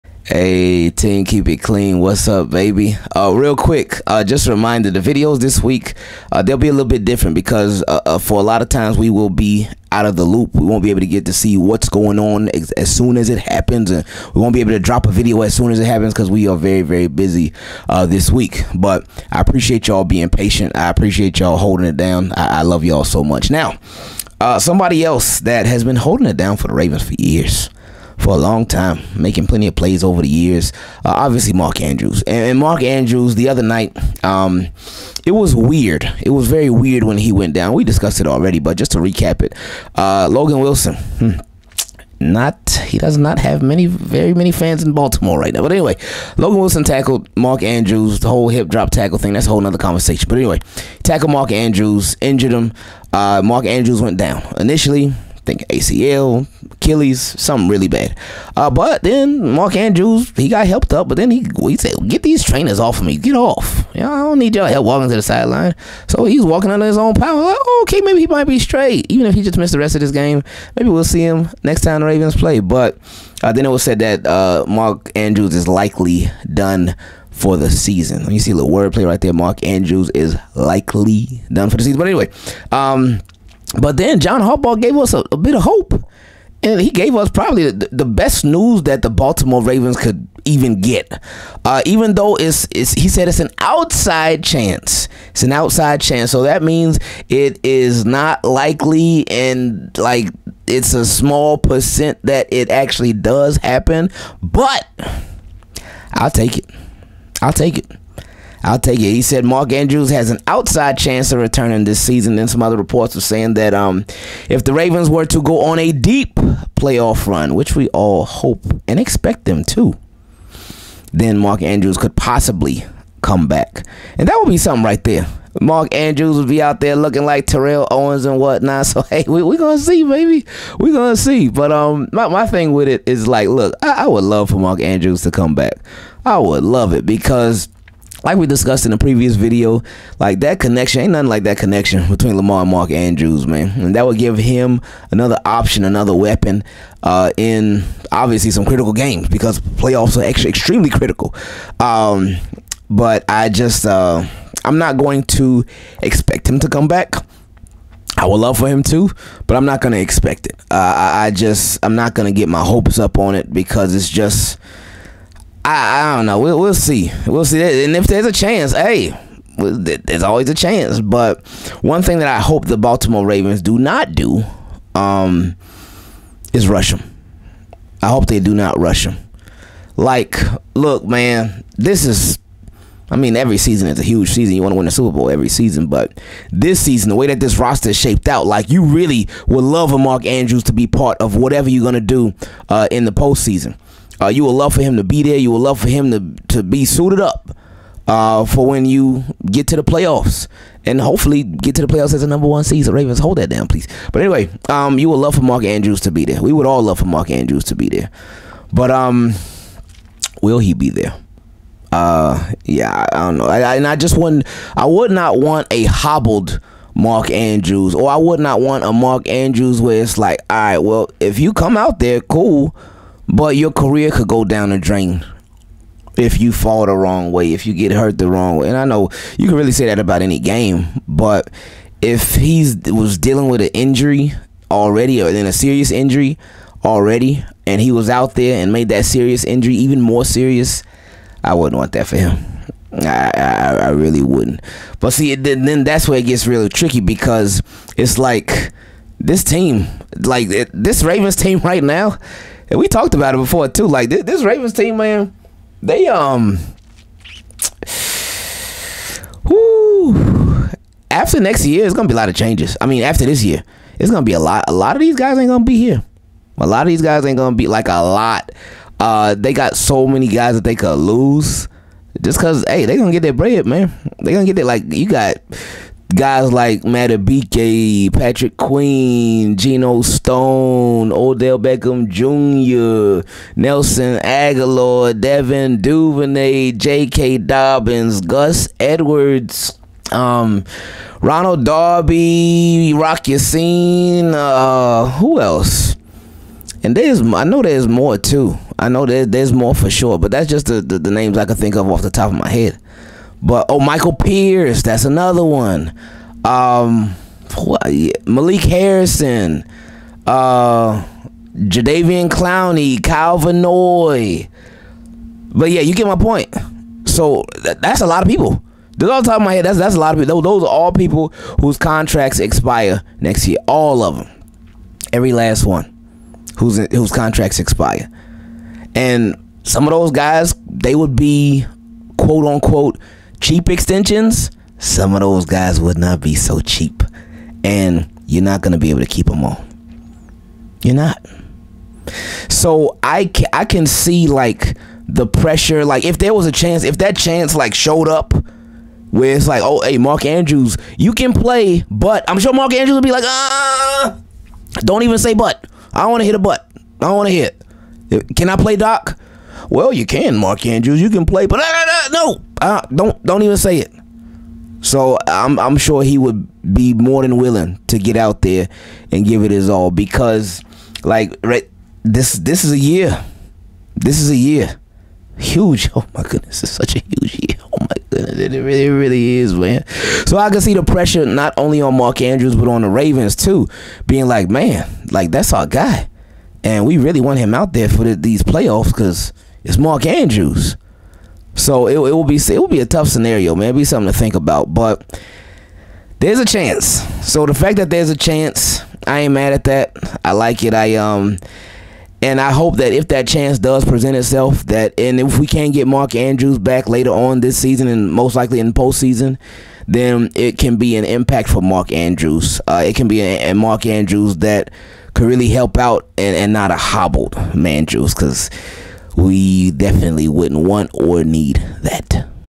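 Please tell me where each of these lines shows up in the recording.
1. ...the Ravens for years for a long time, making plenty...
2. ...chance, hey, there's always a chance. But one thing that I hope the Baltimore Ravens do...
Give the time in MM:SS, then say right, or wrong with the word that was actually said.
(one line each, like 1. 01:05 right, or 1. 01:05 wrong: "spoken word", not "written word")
1. 00:26 right
2. 02:48 right.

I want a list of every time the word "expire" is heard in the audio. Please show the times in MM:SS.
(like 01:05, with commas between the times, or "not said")
05:22, 05:27.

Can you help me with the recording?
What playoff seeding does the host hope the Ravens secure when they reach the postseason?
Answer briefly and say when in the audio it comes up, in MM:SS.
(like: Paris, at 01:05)
Number one seed, at 03:22.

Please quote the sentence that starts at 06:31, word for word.
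So it, it will be it will be a tough scenario, man.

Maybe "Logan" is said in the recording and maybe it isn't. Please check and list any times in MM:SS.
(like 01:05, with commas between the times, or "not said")
00:40, 00:46.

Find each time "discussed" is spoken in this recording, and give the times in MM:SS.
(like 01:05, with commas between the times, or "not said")
00:37, 02:18.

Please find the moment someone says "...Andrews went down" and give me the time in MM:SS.
00:53.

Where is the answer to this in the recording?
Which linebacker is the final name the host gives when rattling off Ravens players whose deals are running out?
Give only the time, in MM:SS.
05:13.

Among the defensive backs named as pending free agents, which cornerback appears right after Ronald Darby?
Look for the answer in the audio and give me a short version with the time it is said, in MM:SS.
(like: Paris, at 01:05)
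Rock Ya-Sin, at 04:52.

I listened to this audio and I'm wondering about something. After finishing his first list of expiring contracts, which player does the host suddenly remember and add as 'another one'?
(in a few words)
Michael Pierce.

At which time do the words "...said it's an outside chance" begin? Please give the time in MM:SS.
01:33.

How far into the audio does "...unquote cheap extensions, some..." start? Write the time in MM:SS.
05:32.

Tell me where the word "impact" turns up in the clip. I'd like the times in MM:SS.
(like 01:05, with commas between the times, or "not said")
06:51.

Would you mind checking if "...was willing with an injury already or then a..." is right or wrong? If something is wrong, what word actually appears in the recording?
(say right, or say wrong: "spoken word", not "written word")
wrong: "dealing", not "willing".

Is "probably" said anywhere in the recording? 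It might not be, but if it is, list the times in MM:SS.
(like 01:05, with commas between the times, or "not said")
01:27.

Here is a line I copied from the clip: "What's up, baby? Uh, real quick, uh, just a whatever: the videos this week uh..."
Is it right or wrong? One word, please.
wrong.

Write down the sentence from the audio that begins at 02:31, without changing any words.
Um, but I just, uh, I'm not going to expect him to come back.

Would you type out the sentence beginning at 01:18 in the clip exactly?
You see a little wordplay right there.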